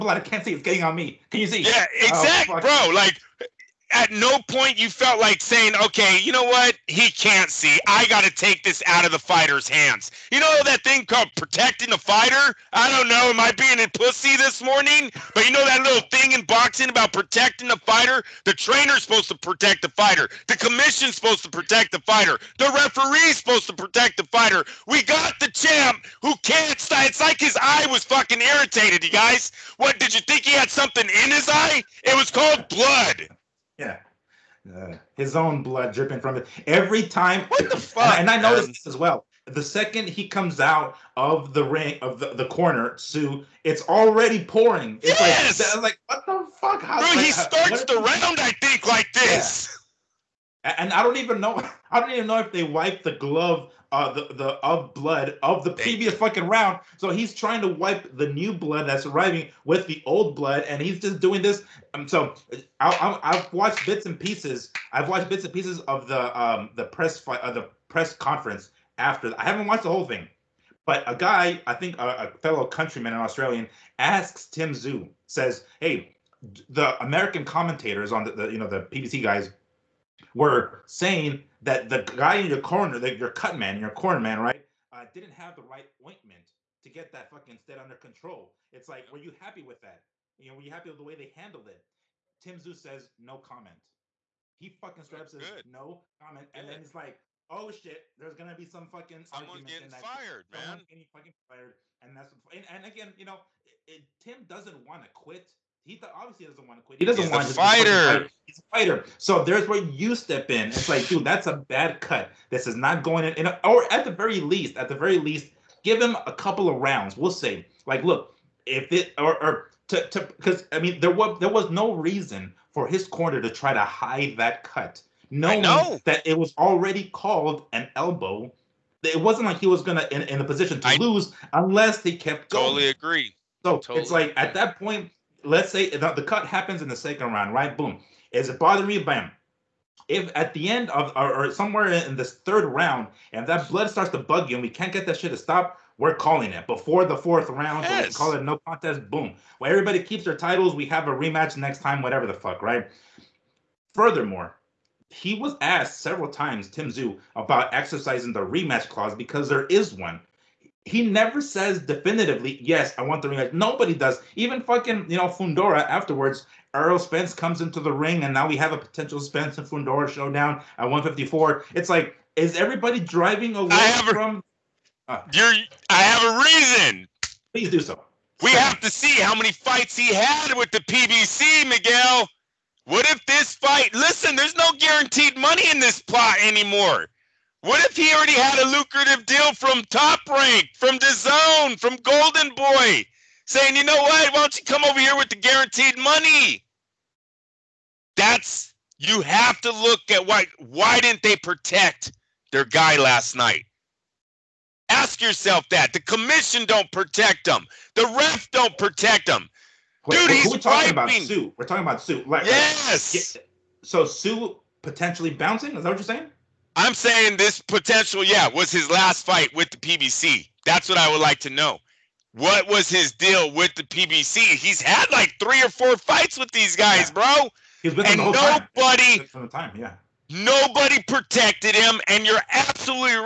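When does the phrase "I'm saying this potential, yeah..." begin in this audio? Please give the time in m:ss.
3:36.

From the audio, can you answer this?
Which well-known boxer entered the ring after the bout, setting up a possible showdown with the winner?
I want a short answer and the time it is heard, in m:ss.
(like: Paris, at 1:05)
Errol Spence, at 2:46.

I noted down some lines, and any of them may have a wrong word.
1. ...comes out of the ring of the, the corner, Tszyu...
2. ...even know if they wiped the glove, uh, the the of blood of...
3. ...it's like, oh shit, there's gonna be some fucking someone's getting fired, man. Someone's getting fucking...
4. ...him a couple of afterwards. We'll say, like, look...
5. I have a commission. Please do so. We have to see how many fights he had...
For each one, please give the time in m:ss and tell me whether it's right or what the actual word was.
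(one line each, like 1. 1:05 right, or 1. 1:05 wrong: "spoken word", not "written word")
1. 0:40 right
2. 0:52 right
3. 1:36 right
4. 1:56 wrong: "rounds", not "afterwards"
5. 2:55 wrong: "reason", not "commission".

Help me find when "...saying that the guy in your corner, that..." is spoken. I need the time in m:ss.
1:20.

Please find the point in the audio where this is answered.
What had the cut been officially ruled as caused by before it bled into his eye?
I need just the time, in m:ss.
2:07.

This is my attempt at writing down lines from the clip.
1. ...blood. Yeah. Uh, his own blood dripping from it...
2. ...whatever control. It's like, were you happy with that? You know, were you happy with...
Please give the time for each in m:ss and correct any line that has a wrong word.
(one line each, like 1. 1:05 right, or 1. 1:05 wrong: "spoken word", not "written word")
1. 0:32 right
2. 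1:27 wrong: "under", not "whatever".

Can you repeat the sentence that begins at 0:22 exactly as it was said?
The referee's supposed to protect the fighter.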